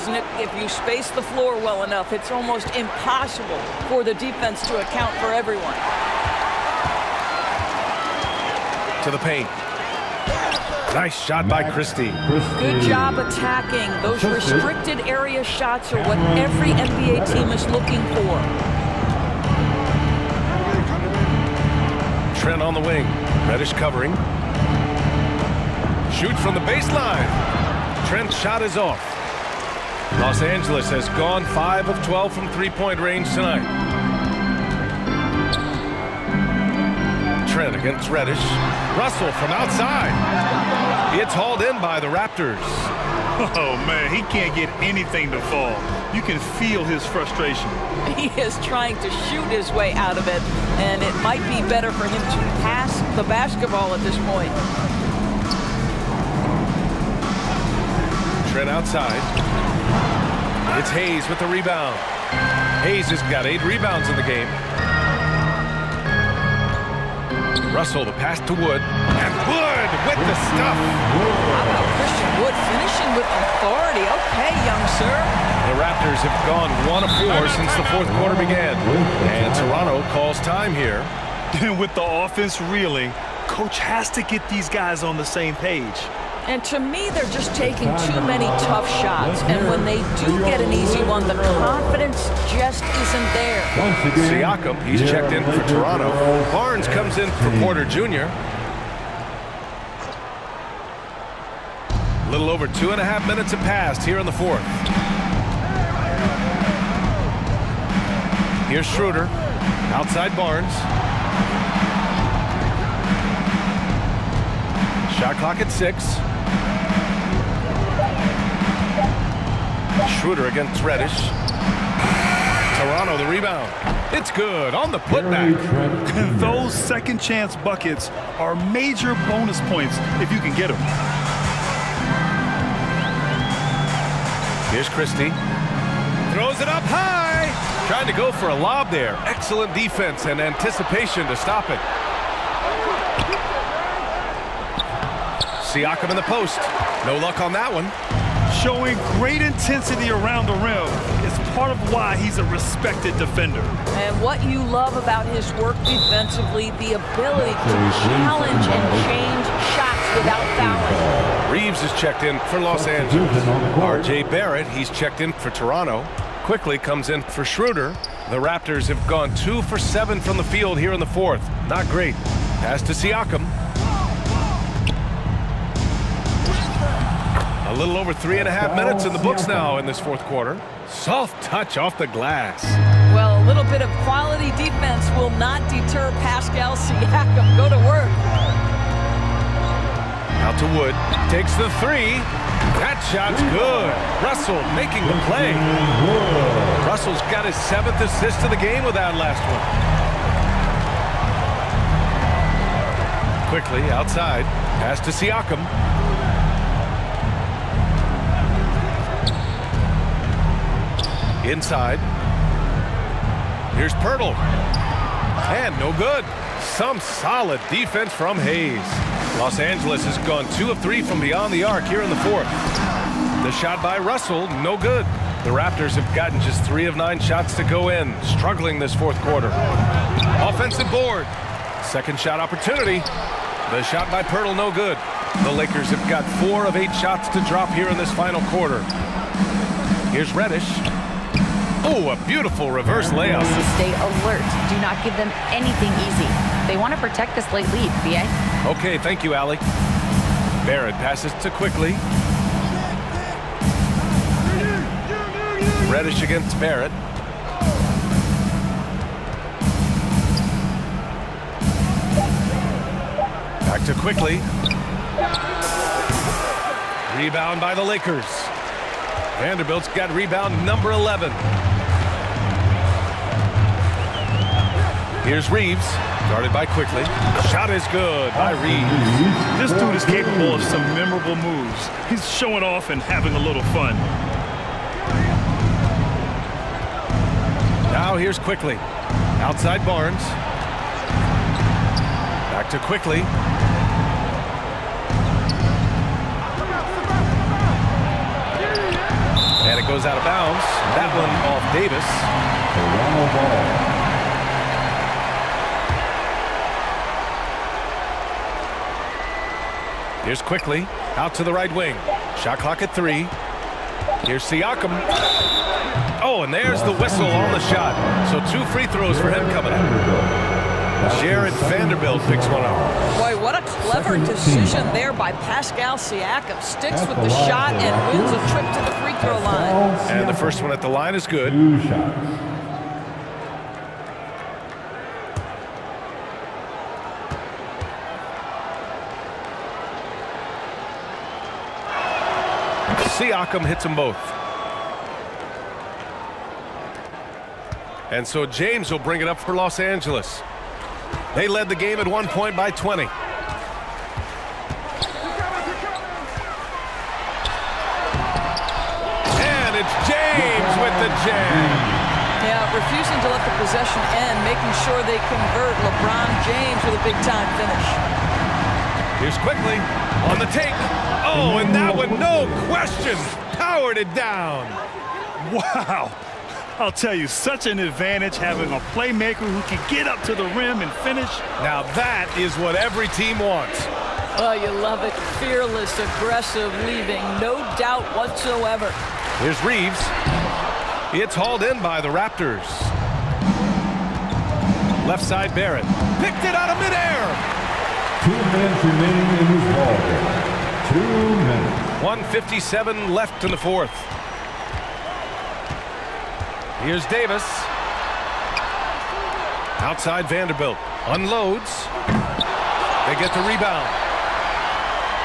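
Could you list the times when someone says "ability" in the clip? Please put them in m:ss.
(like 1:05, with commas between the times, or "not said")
2:36.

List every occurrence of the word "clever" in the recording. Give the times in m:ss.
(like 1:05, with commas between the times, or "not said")
5:23.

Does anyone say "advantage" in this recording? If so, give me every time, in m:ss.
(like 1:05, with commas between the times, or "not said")
6:17.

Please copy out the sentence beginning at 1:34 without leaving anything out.
Siakam, he's checked in for Toronto.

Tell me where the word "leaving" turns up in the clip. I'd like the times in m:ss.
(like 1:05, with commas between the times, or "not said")
6:26.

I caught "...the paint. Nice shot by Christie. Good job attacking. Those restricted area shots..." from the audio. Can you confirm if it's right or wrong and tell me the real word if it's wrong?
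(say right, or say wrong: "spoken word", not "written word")
right.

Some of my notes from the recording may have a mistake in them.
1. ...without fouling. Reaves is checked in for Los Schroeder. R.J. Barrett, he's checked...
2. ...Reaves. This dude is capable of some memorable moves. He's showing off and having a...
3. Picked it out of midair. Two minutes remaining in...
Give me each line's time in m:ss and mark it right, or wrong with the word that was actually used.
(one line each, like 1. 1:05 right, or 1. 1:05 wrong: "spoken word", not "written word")
1. 2:40 wrong: "Angeles", not "Schroeder"
2. 4:38 right
3. 6:36 right.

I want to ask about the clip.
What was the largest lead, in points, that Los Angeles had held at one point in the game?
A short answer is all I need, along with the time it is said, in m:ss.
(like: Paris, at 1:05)
20, at 5:52.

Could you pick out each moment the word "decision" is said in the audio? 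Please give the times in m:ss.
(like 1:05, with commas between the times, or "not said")
5:24.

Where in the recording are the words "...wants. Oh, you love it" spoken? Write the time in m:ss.
6:23.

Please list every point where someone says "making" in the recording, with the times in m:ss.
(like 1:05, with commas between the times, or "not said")
3:14, 6:04.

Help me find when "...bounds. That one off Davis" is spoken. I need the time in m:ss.
5:00.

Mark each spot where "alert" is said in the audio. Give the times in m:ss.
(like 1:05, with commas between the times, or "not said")
4:03.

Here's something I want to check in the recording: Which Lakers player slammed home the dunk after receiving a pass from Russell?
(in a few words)
Christian Wood.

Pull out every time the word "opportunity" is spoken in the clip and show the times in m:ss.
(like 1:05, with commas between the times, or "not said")
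3:52.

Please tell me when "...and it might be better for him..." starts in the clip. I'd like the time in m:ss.
0:50.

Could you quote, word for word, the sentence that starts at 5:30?
And the first one at the line is good.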